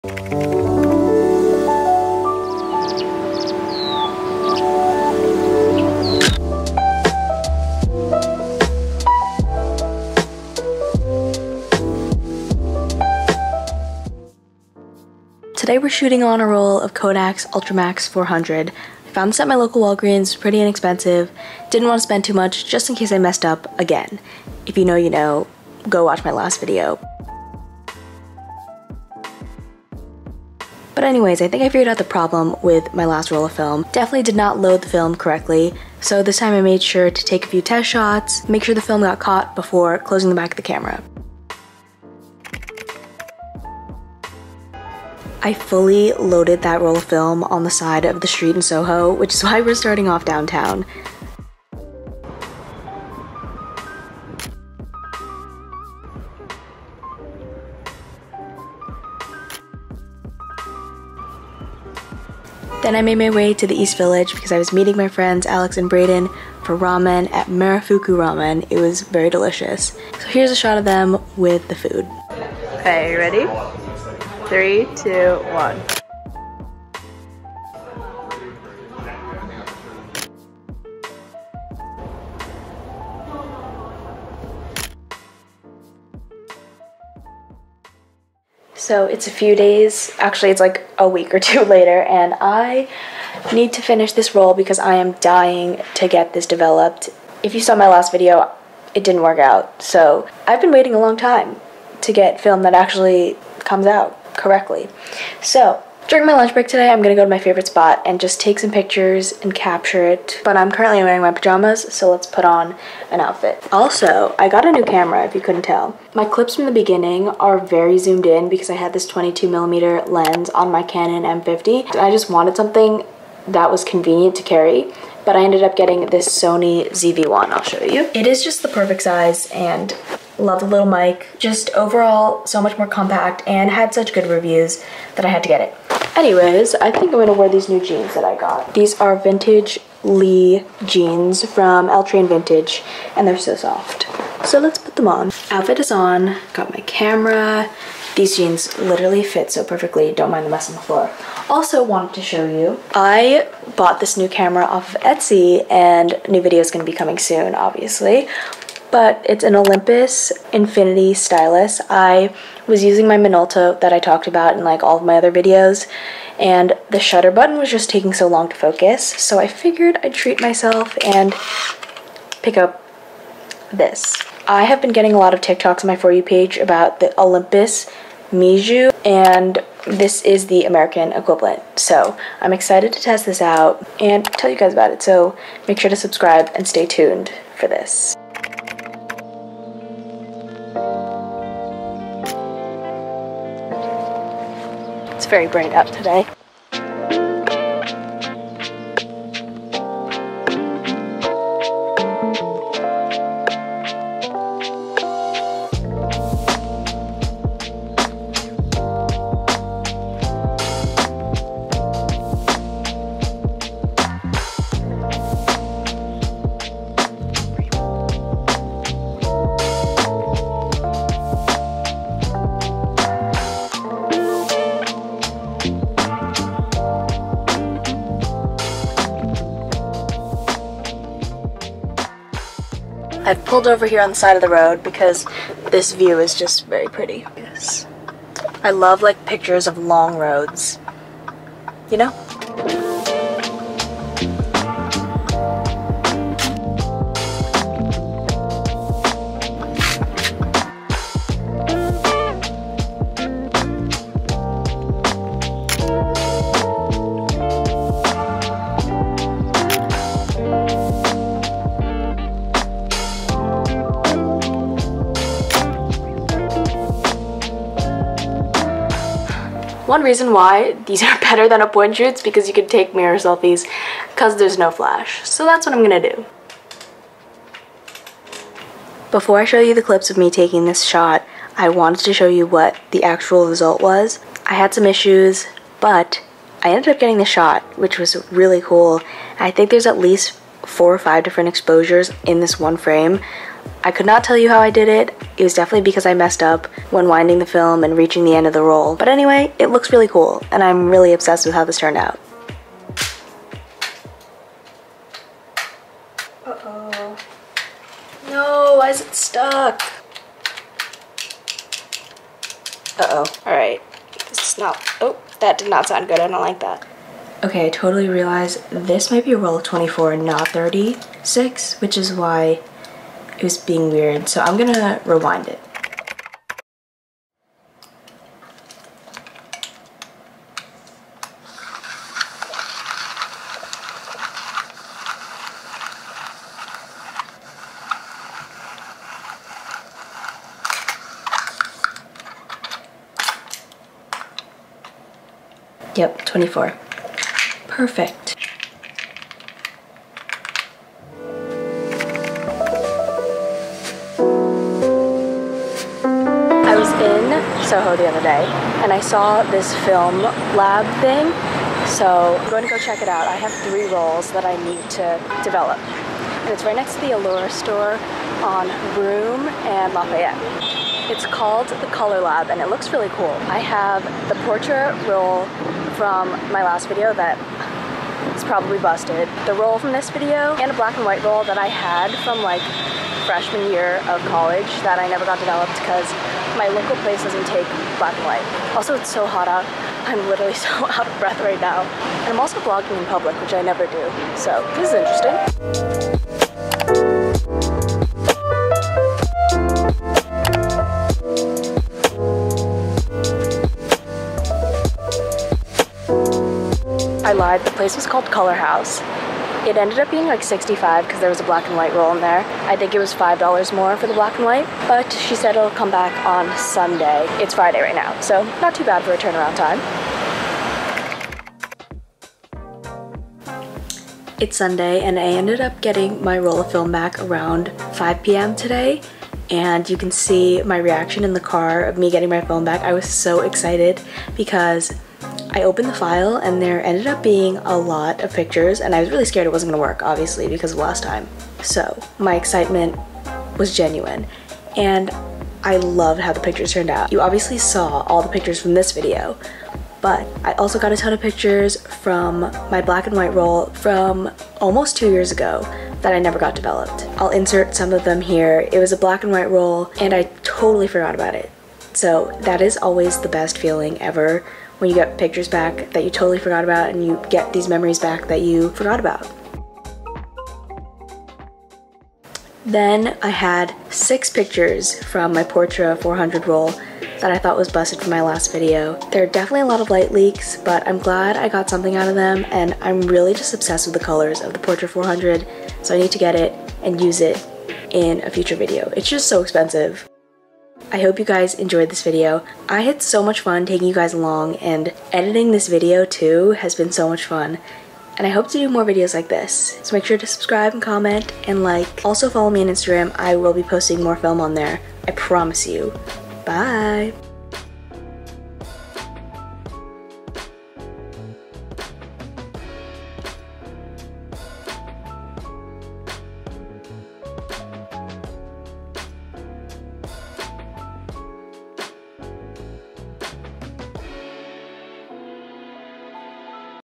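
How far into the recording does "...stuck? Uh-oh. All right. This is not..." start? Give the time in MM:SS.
05:09.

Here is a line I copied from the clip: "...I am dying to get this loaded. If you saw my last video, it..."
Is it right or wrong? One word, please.
wrong.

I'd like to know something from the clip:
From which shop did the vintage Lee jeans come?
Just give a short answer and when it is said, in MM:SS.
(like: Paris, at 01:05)
L Train Vintage, at 02:21.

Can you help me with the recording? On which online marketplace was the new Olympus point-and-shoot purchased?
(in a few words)
Etsy.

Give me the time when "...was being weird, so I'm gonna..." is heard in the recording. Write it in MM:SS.
05:23.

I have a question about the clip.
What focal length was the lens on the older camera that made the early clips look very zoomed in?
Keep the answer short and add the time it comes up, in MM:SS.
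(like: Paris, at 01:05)
22 millimeter, at 01:59.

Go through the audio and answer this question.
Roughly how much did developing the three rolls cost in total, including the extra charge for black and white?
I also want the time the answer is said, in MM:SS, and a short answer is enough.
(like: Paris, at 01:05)
$65, at 06:50.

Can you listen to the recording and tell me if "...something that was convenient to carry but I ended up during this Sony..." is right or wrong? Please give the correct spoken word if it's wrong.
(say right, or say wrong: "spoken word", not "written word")
wrong: "getting", not "during".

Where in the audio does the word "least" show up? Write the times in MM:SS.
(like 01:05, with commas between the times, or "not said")
04:49.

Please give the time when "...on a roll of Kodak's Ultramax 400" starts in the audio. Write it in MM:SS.
00:16.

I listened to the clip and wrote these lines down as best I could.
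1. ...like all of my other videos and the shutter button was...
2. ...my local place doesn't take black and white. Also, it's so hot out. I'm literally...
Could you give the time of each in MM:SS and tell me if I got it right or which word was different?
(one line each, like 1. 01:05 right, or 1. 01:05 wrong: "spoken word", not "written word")
1. 02:44 right
2. 06:26 right.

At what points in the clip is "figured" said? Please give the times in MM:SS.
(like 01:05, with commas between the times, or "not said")
00:31, 02:49.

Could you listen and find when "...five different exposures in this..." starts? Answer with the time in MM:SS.
04:50.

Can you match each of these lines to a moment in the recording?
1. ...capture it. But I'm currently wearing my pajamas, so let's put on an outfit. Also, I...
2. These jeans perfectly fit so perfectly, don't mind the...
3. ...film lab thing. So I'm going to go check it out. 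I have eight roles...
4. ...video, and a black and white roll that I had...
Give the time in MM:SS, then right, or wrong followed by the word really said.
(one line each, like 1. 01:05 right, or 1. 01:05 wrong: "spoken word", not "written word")
1. 01:49 right
2. 02:28 wrong: "literally", not "perfectly"
3. 05:59 wrong: "three", not "eight"
4. 06:20 right.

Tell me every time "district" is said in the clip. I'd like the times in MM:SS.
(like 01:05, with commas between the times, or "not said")
not said.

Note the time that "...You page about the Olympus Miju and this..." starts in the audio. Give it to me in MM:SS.
02:56.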